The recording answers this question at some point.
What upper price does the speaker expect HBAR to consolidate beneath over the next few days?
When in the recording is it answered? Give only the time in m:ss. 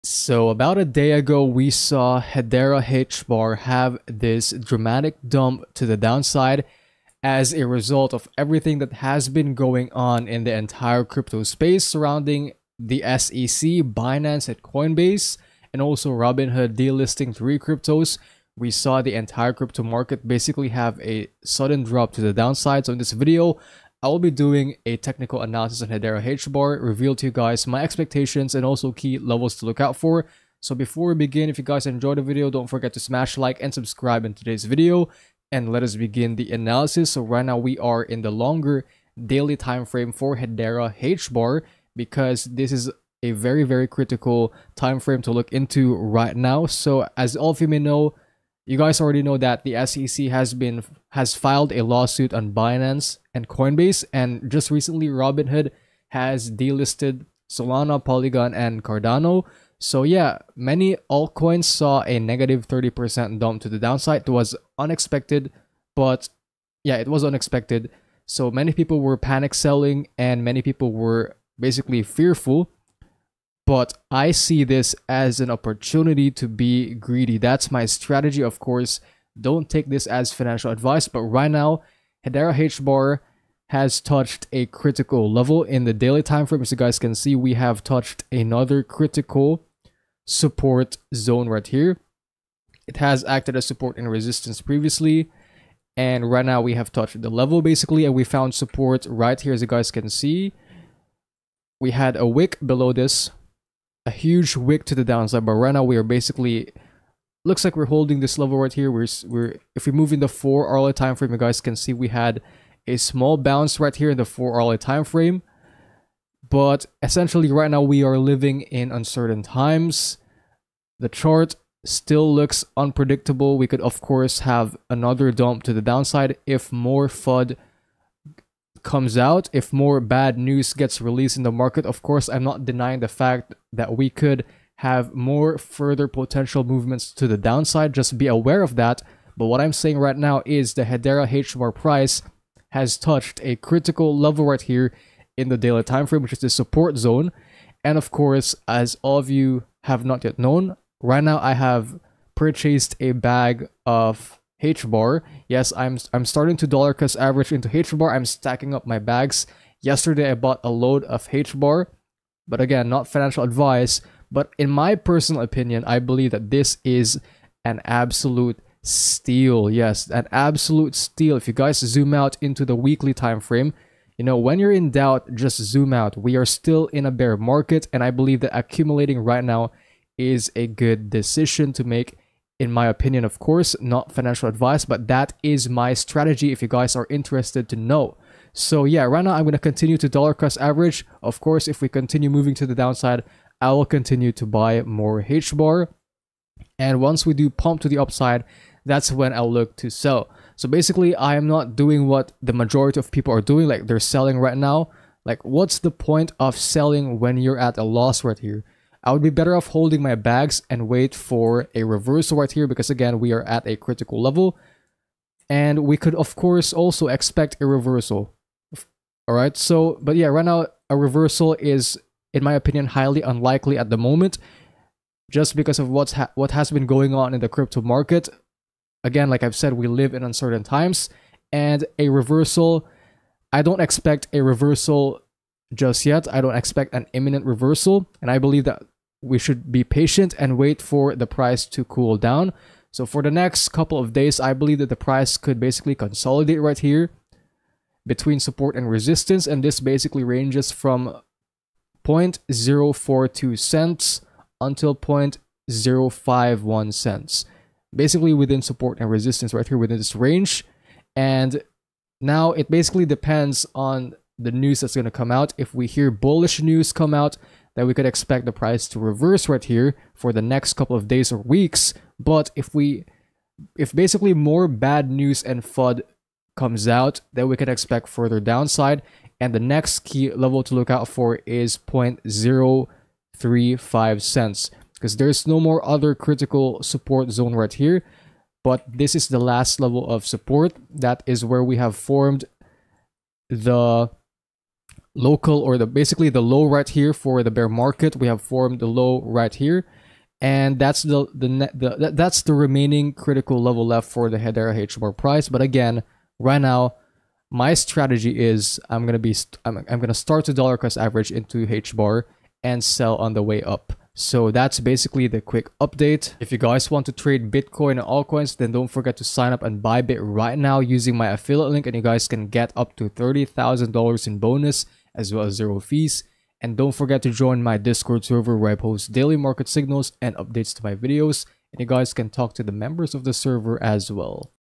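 4:14.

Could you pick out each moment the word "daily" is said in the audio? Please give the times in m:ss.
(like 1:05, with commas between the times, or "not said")
0:39, 1:25, 2:25, 5:29.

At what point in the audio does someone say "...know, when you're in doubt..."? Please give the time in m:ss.
2:54.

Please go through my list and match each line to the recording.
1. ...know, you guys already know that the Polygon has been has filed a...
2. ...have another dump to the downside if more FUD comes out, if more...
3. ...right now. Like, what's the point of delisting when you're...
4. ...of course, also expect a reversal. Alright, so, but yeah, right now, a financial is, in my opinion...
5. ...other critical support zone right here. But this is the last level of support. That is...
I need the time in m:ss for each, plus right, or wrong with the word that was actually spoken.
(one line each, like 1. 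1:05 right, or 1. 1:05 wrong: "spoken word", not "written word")
1. 0:47 wrong: "SEC", not "Polygon"
2. 2:04 right
3. 3:24 wrong: "selling", not "delisting"
4. 3:36 wrong: "reversal", not "financial"
5. 4:45 right.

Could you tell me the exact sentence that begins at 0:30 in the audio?
So before we begin, if you guys enjoyed the video, don't forget to smash like and subscribe in today's video.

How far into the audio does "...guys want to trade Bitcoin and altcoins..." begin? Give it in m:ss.
5:16.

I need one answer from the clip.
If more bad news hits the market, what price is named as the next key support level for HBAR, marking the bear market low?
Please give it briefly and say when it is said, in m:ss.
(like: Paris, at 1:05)
0.035, at 4:41.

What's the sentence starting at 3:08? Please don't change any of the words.
So yeah, right now I'm going to continue to dollar cost average.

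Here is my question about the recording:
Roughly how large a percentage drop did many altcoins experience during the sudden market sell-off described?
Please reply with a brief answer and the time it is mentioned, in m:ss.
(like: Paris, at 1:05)
30%, at 1:02.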